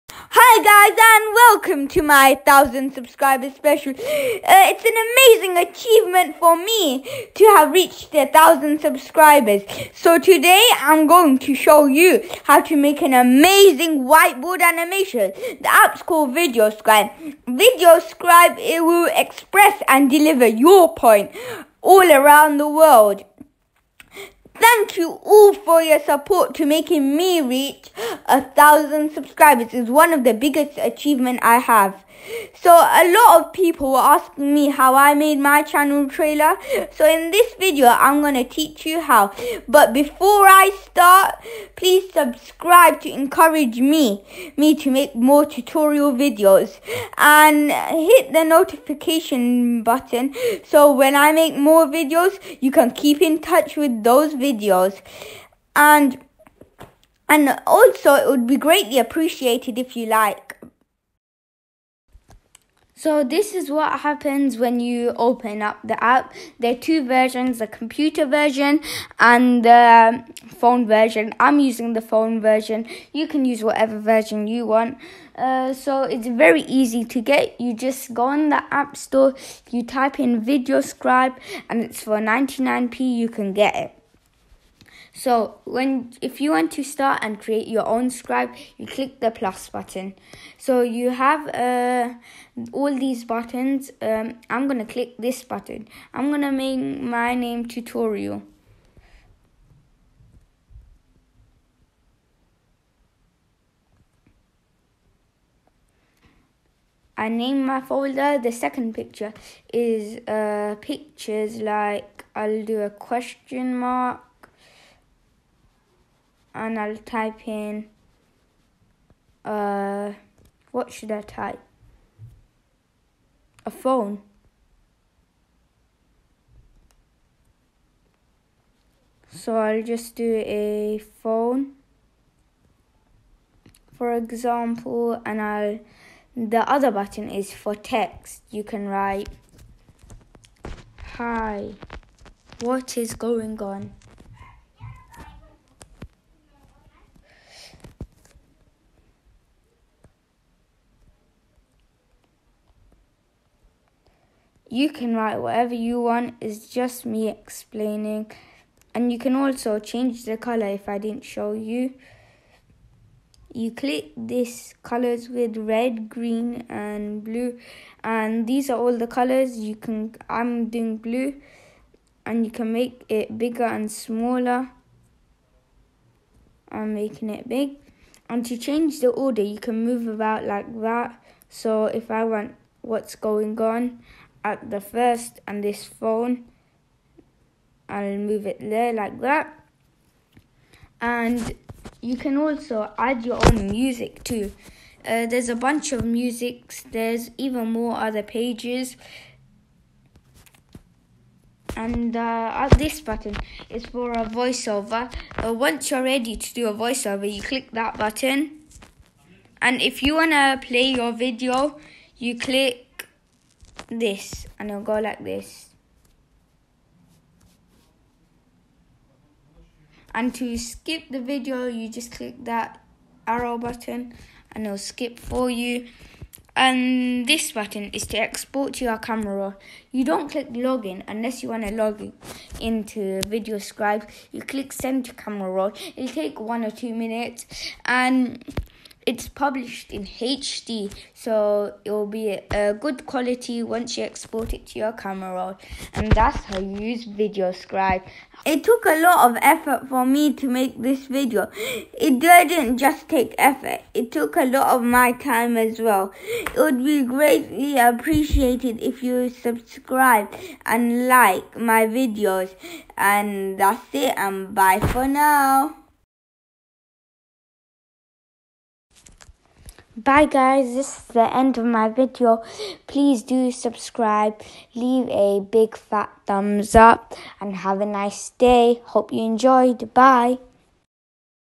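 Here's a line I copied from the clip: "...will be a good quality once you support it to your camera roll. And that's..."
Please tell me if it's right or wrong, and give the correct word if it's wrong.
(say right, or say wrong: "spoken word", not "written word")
wrong: "export", not "support".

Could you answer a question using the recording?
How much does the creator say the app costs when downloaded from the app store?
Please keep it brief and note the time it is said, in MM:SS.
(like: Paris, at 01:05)
99p, at 01:22.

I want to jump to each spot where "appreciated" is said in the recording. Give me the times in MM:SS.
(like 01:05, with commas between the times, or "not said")
00:58, 04:17.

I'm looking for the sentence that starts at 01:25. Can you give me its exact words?
So when if you want to start and create your own scribe, you click the plus button.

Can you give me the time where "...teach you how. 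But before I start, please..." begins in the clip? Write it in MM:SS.
00:38.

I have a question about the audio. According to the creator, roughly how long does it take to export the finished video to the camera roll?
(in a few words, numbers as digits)
one or two minutes.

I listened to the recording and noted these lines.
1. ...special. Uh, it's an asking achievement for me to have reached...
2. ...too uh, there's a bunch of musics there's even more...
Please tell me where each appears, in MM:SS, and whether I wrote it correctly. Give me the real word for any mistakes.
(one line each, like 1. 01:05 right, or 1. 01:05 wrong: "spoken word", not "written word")
1. 00:03 wrong: "amazing", not "asking"
2. 03:14 right.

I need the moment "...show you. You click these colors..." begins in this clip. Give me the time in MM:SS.
02:41.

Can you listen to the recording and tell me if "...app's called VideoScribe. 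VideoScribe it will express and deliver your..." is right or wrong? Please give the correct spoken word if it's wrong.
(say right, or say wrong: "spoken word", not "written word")
right.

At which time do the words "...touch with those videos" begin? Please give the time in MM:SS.
00:53.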